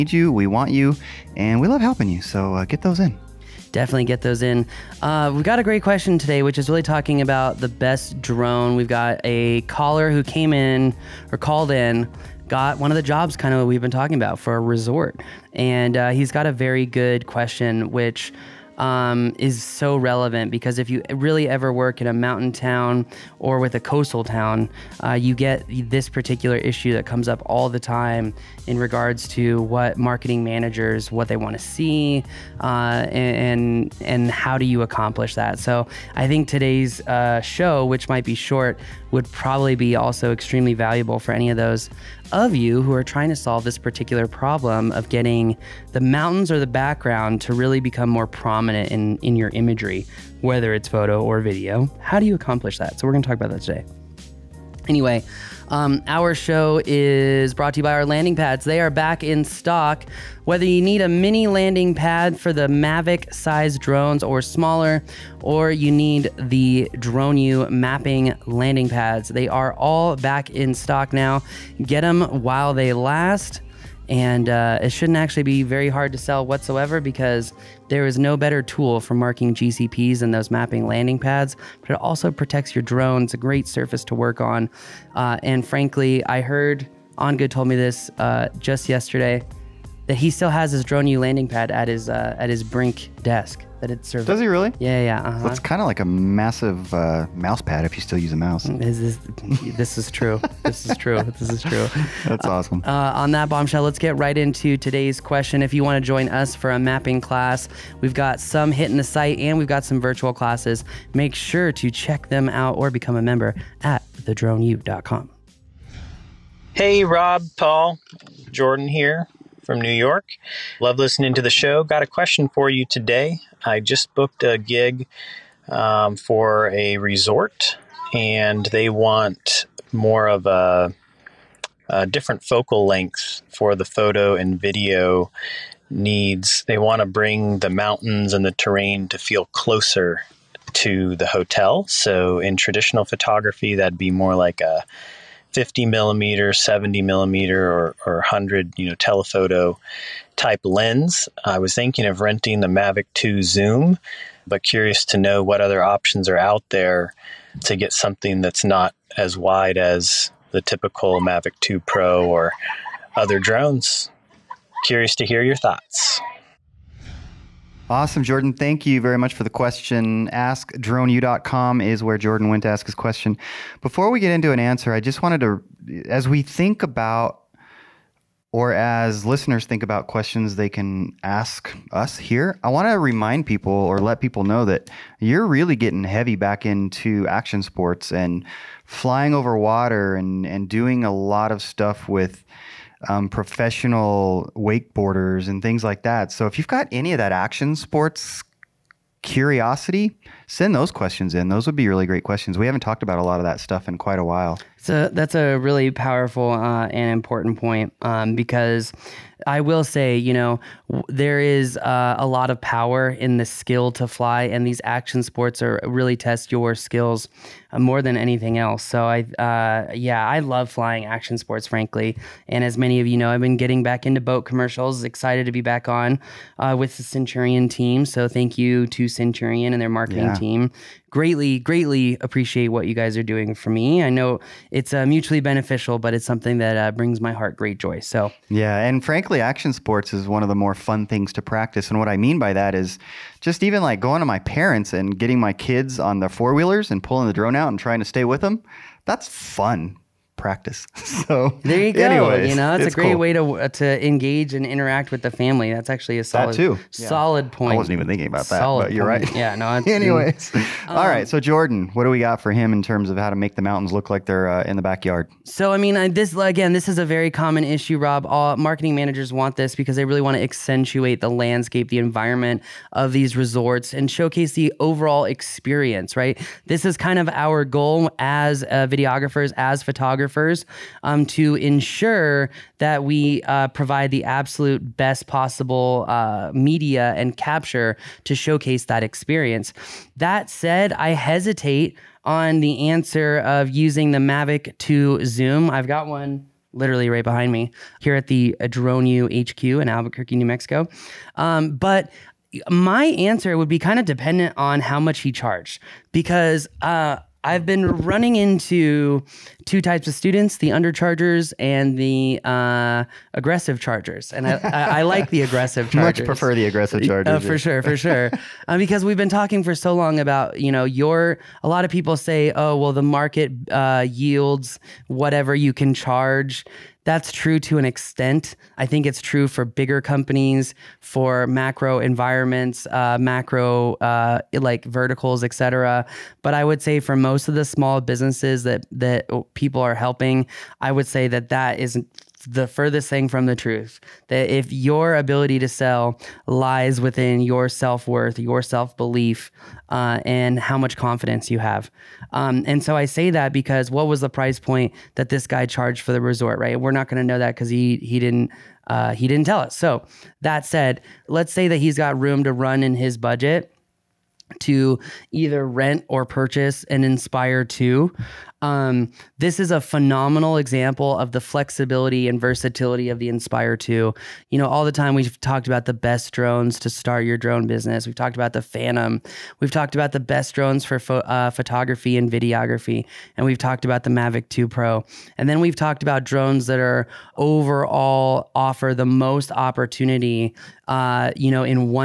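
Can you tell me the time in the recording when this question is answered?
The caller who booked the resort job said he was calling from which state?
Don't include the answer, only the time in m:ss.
1:59.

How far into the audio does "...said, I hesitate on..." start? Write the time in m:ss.
4:50.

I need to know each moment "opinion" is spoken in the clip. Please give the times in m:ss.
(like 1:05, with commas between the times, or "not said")
not said.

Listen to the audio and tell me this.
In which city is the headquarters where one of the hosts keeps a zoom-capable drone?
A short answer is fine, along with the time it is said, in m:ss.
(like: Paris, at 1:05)
Albuquerque, at 4:59.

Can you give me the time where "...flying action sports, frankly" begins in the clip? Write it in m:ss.
3:40.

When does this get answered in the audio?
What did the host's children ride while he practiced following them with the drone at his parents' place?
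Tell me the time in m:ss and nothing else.
4:06.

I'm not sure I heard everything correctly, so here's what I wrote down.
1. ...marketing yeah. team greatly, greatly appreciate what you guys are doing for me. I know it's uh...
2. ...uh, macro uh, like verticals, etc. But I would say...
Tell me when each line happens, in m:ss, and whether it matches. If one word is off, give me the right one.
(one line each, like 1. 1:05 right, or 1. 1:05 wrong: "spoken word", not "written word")
1. 3:49 right
2. 5:32 right.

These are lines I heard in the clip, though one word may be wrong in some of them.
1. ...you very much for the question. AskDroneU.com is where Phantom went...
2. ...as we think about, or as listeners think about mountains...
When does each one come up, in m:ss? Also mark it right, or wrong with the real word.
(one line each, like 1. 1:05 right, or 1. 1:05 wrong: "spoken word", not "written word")
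1. 2:48 wrong: "Jordan", not "Phantom"
2. 2:56 wrong: "questions", not "mountains".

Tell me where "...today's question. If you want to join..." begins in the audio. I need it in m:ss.
1:44.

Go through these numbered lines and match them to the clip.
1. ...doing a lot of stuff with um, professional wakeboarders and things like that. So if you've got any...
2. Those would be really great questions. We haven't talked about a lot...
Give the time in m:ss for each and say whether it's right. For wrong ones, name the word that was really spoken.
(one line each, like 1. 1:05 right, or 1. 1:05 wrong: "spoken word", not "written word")
1. 3:10 right
2. 3:21 right.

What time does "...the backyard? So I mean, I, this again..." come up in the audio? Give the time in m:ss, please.
4:24.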